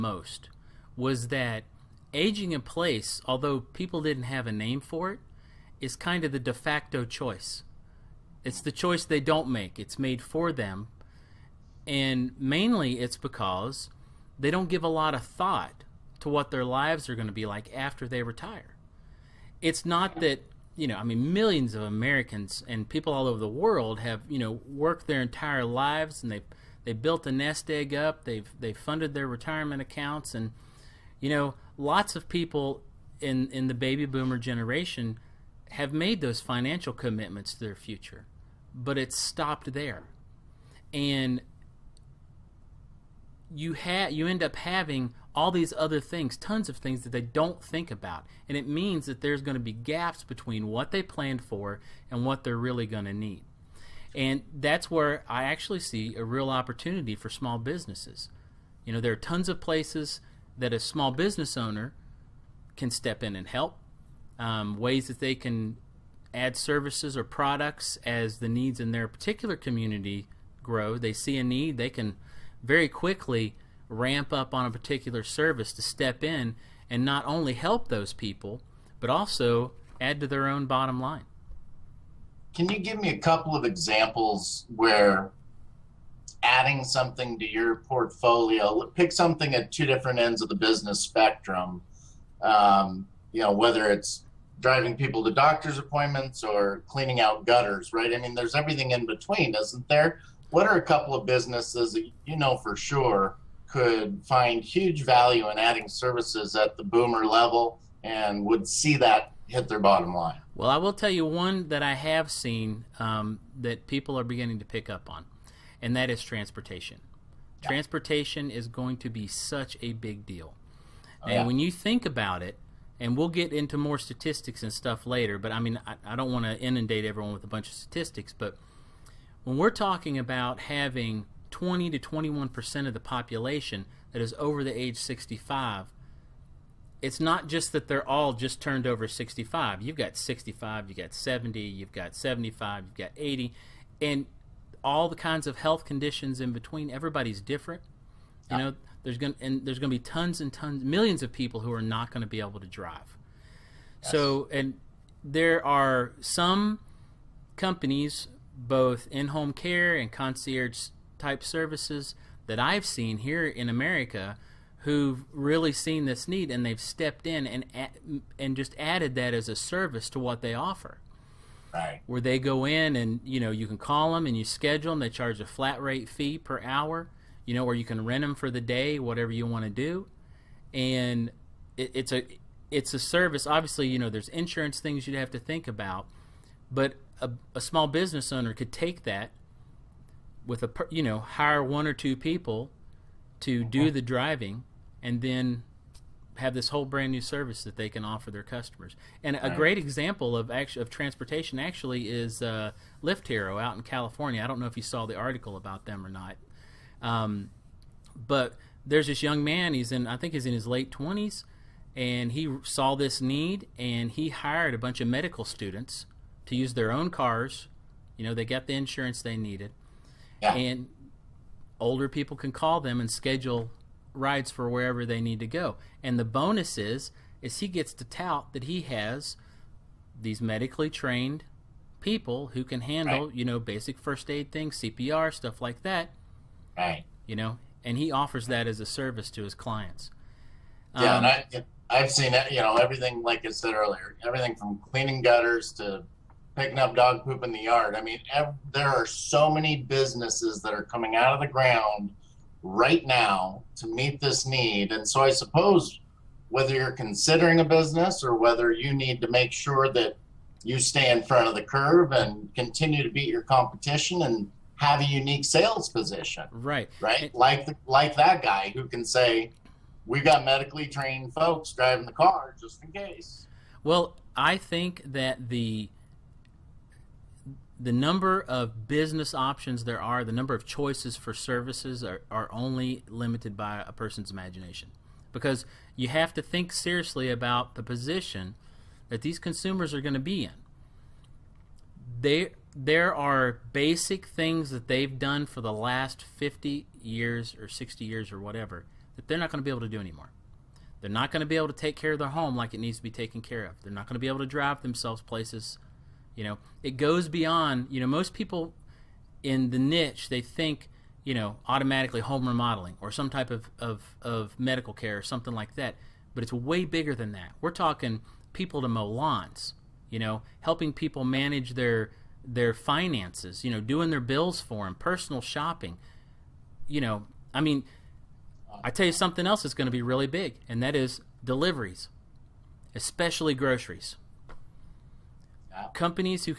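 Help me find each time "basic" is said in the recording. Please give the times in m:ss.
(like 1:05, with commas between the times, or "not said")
3:53, 4:53.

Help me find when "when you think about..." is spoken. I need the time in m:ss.
2:01.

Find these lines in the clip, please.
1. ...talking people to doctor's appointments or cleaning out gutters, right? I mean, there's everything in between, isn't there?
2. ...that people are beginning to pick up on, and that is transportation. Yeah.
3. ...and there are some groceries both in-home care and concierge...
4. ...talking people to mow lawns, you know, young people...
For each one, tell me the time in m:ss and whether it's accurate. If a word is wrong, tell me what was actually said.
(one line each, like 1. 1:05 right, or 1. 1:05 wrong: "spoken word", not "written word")
1. 1:34 wrong: "driving", not "talking"
2. 1:53 right
3. 2:34 wrong: "companies", not "groceries"
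4. 5:17 wrong: "helping", not "young".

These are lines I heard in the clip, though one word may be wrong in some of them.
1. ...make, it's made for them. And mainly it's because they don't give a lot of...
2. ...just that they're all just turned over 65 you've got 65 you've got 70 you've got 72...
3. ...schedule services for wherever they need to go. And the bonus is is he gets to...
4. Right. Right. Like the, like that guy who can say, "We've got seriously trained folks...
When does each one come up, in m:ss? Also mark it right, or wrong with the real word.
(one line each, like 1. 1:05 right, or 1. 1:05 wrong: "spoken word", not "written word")
1. 0:09 right
2. 2:17 wrong: "75", not "72"
3. 3:43 wrong: "rides", not "services"
4. 4:26 wrong: "medically", not "seriously".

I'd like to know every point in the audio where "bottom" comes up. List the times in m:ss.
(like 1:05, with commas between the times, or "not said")
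1:20, 1:49.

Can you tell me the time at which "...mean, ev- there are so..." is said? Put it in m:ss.
4:08.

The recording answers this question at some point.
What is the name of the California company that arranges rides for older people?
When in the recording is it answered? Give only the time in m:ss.
3:23.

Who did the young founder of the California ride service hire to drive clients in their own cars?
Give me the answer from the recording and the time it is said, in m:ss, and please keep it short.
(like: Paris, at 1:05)
Medical students, at 3:35.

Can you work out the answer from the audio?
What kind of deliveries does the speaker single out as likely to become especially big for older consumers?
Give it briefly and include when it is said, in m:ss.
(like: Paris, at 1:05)
Groceries, at 5:33.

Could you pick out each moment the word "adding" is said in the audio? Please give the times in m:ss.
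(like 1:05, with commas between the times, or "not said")
1:26, 1:45.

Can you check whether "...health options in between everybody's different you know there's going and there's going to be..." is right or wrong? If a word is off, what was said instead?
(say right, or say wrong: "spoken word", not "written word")
wrong: "conditions", not "options".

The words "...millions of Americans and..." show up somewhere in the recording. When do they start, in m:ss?
0:21.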